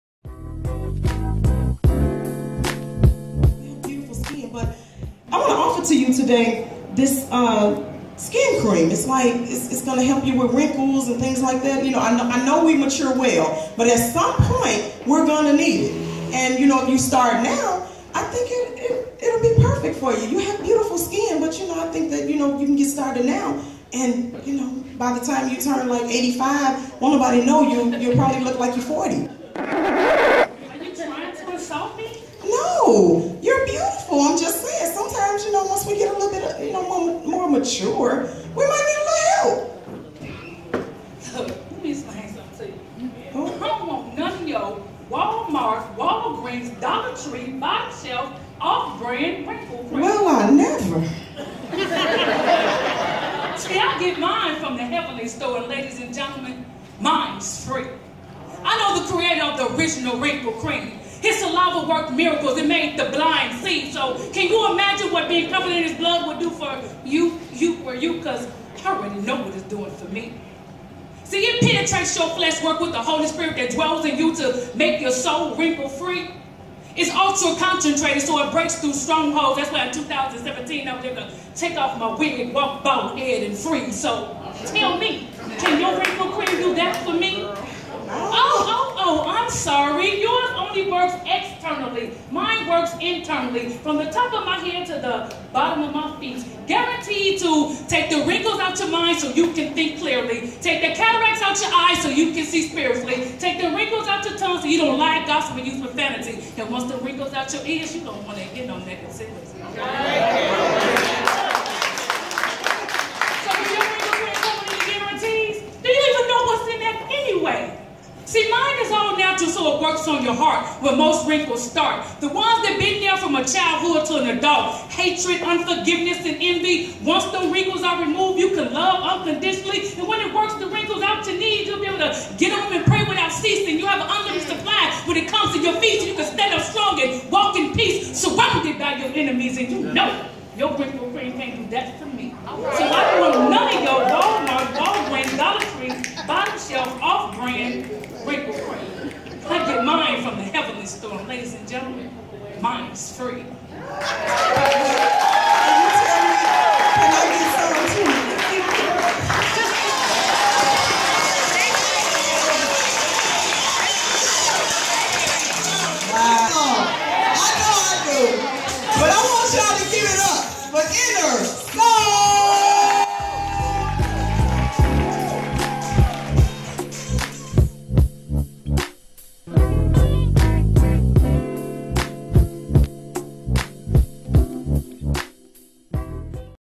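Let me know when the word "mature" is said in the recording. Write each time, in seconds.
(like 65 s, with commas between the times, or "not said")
12 s, 37 s.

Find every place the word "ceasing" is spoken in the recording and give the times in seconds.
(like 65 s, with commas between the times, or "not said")
133 s.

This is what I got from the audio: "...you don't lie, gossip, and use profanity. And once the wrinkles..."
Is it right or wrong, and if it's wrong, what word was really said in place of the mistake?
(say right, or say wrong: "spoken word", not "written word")
right.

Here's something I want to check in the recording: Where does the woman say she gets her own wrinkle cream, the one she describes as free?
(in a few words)
The Heavenly Store.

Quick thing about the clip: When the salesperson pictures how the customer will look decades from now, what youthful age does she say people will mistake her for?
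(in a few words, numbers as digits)
40.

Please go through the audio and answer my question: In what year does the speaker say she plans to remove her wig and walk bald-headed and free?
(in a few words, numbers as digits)
2017.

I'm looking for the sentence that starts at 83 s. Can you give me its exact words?
So tell me, can your wrinkle cream do that for me?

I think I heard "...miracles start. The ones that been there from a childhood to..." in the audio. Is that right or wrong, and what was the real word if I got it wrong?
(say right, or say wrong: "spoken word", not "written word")
wrong: "wrinkles", not "miracles".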